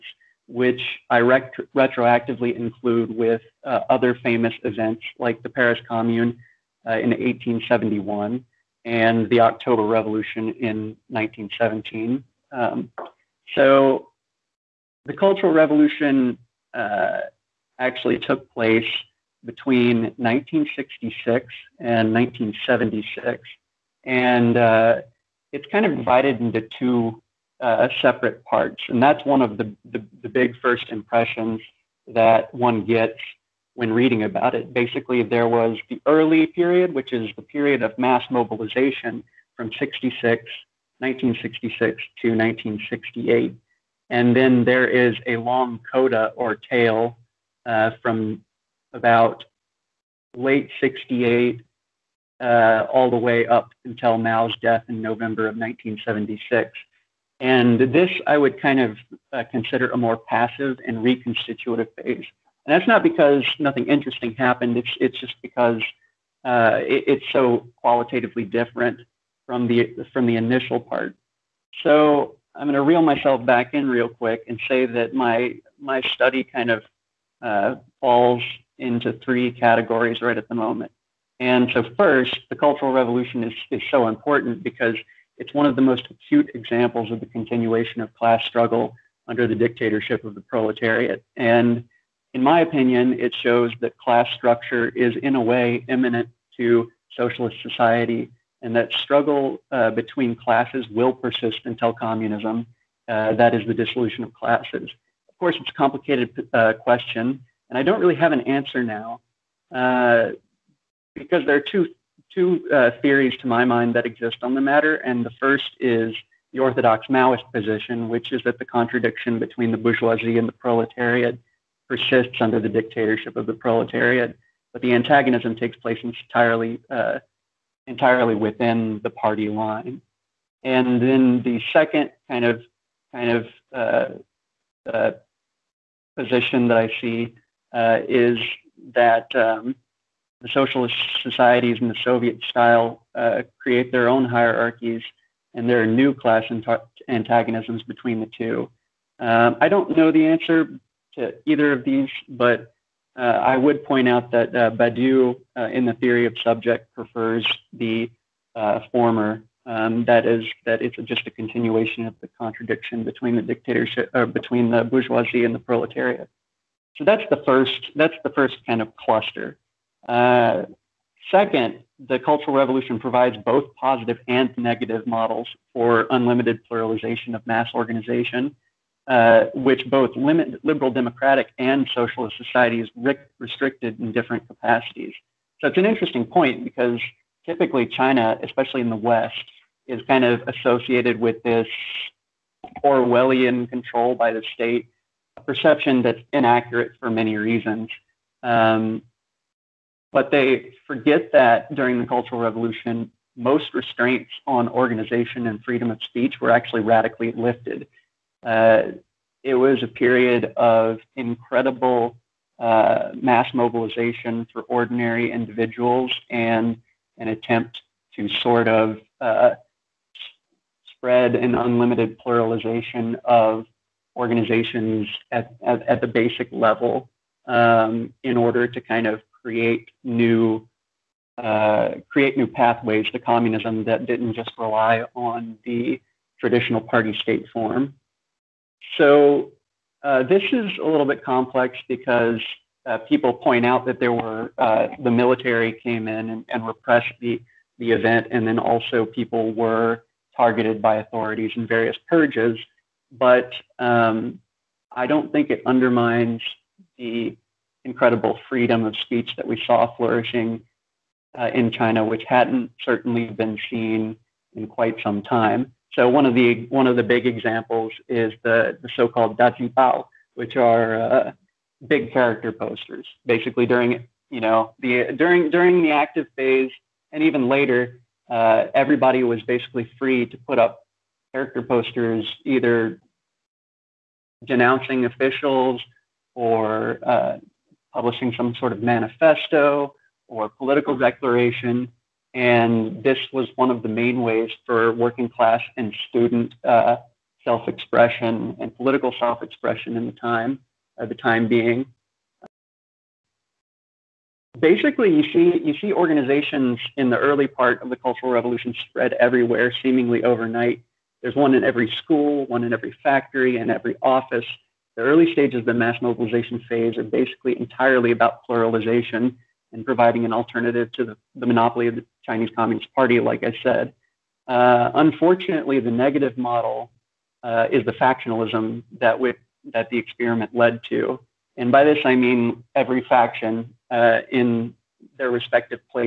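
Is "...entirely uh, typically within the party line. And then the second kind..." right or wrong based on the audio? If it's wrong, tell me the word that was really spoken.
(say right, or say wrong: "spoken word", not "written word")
wrong: "entirely", not "typically".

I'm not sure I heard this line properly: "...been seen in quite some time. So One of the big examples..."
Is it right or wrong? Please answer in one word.
right.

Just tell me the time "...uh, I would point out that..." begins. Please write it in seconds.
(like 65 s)
153 s.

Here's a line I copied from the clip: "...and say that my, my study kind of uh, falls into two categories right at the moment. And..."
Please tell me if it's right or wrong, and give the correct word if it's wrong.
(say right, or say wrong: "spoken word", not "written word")
wrong: "three", not "two".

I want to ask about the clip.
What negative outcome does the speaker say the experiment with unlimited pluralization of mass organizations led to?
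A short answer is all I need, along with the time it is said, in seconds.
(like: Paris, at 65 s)
factionalism, at 327 s.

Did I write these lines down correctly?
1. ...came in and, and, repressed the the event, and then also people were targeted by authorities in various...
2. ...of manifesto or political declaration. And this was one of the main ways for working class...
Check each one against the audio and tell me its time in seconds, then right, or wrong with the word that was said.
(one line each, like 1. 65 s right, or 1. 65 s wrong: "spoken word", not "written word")
1. 245 s right
2. 288 s right.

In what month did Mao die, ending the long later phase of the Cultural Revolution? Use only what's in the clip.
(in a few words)
November.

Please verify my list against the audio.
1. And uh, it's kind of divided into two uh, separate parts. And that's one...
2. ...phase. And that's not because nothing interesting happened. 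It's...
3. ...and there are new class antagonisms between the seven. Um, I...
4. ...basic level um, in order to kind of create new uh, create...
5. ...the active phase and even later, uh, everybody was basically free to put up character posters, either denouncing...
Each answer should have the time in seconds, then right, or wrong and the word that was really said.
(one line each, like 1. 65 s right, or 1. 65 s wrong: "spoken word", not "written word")
1. 24 s right
2. 61 s right
3. 145 s wrong: "two", not "seven"
4. 226 s right
5. 274 s right.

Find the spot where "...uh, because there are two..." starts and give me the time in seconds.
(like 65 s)
109 s.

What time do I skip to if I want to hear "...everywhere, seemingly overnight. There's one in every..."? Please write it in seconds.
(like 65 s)
309 s.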